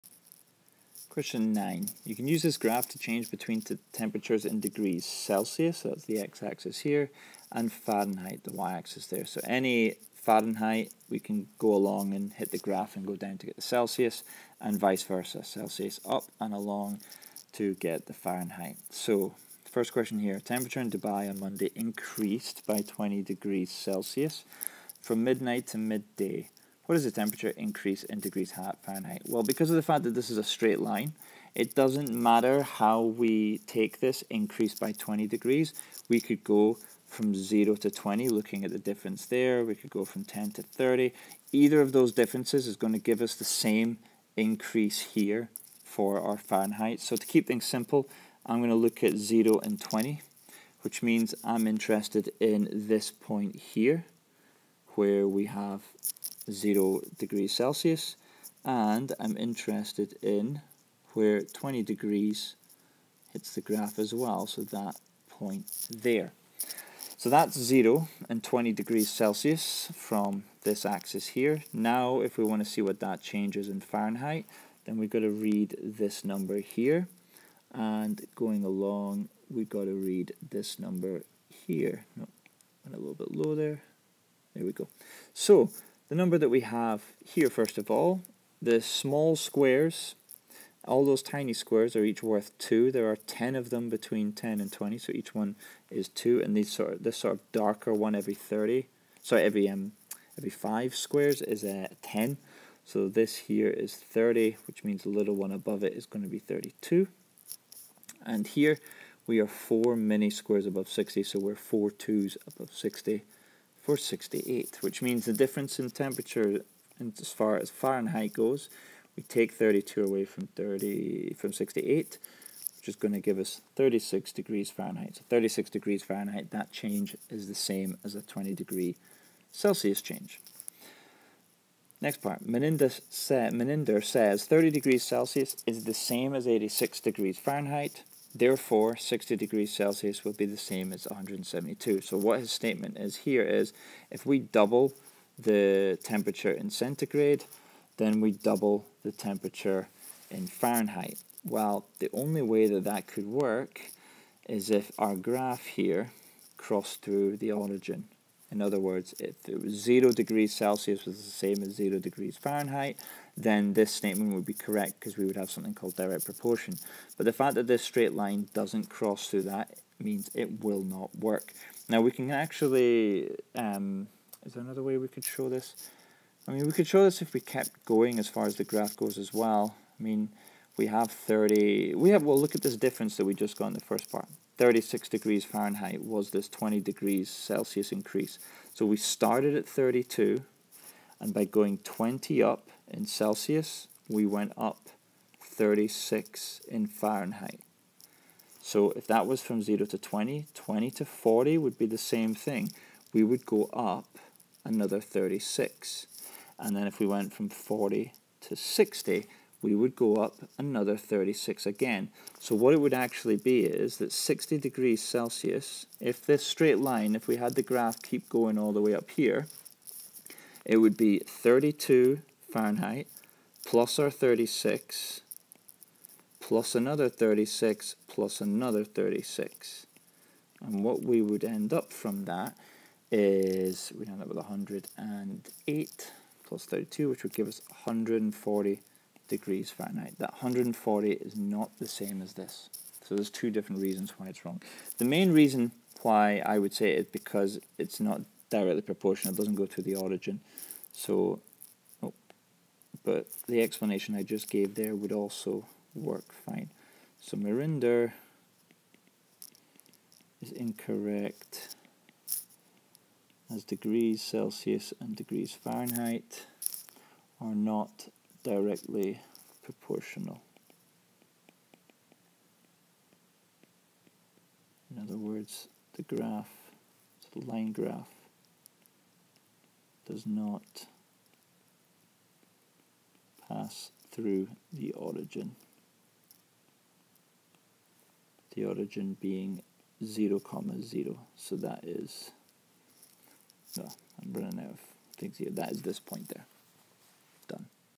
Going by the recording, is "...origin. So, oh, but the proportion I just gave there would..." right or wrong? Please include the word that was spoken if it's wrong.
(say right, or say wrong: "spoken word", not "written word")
wrong: "explanation", not "proportion".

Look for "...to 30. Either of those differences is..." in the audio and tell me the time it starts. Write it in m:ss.
0:40.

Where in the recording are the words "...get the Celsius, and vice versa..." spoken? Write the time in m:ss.
0:13.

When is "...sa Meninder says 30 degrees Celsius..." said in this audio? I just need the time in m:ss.
2:13.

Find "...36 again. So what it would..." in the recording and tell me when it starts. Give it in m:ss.
3:30.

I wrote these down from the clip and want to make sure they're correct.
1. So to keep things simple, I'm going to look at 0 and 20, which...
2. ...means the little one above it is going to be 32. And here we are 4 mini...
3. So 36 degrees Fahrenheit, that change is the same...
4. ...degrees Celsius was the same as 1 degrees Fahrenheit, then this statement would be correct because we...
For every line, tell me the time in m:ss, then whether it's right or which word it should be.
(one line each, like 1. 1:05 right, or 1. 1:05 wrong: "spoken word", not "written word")
1. 0:46 right
2. 1:44 right
3. 2:05 right
4. 2:40 wrong: "0", not "1".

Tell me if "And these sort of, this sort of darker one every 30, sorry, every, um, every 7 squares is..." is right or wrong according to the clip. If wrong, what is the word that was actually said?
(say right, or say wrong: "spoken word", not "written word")
wrong: "5", not "7".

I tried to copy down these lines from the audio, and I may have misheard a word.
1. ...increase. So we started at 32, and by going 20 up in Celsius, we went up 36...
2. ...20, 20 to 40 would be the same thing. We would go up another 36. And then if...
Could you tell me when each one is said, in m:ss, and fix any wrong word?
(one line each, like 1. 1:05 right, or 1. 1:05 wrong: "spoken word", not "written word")
1. 3:07 right
2. 3:19 right.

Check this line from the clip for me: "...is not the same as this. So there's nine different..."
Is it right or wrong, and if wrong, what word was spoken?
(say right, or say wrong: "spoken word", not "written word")
wrong: "two", not "nine".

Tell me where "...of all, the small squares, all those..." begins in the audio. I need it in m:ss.
1:27.